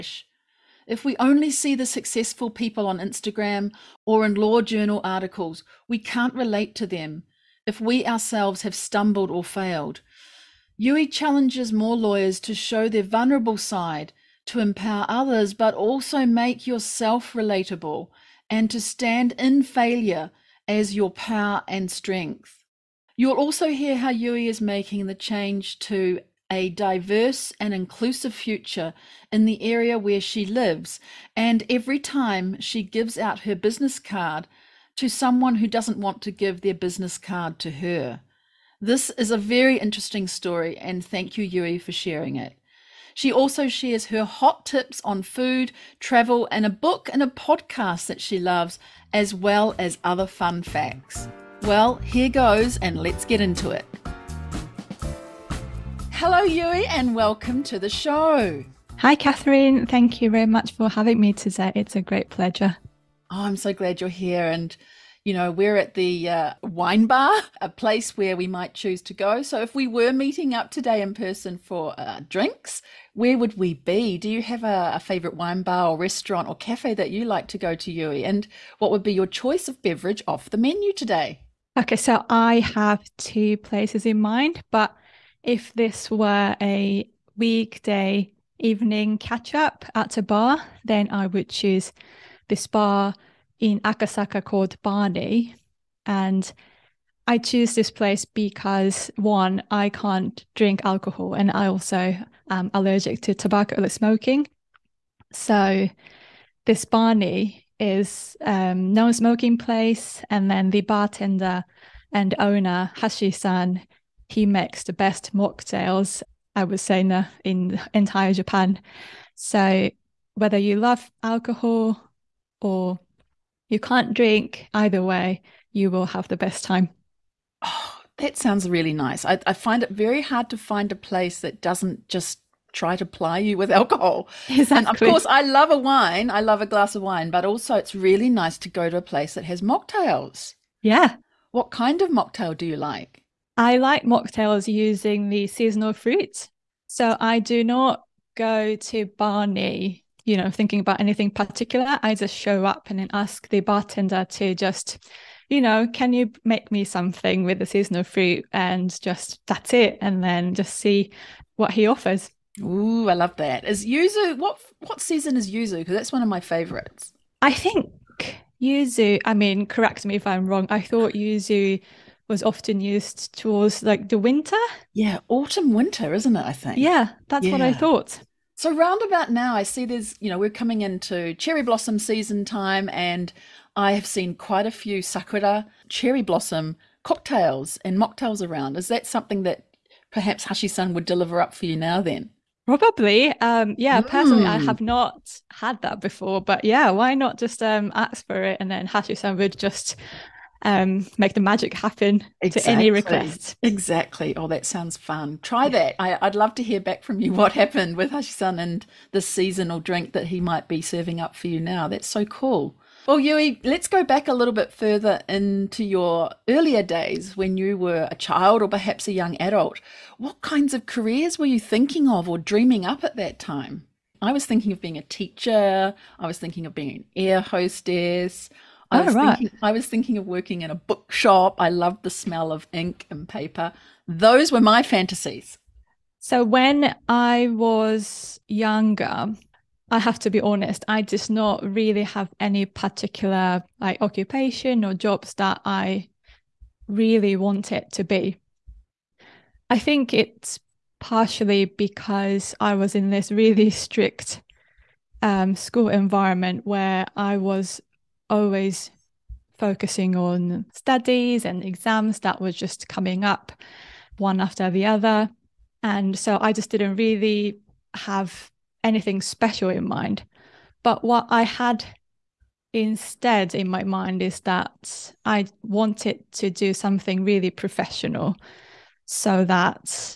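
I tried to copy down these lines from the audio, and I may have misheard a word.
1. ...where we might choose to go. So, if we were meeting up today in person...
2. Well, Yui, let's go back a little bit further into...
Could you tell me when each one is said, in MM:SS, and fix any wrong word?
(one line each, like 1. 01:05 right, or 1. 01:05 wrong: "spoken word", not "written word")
1. 01:08 right
2. 03:33 right.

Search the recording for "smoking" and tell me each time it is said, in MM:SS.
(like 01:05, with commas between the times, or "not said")
01:43, 01:48.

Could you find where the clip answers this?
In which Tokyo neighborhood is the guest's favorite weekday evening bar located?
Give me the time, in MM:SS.
01:33.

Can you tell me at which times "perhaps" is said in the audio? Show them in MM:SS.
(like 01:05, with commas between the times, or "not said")
03:10, 03:38.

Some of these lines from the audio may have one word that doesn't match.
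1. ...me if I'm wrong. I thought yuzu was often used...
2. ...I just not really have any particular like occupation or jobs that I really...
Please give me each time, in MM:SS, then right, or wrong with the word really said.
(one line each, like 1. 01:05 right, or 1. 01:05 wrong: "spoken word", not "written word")
1. 02:50 right
2. 04:00 right.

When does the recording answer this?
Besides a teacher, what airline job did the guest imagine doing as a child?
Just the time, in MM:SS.
03:47.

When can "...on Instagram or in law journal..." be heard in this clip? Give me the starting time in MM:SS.
00:02.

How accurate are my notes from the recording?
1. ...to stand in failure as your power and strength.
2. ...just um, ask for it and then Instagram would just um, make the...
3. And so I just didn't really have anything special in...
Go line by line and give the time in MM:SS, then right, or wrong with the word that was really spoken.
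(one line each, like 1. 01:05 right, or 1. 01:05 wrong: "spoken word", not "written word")
1. 00:18 right
2. 03:17 wrong: "Hashisan", not "Instagram"
3. 04:25 right.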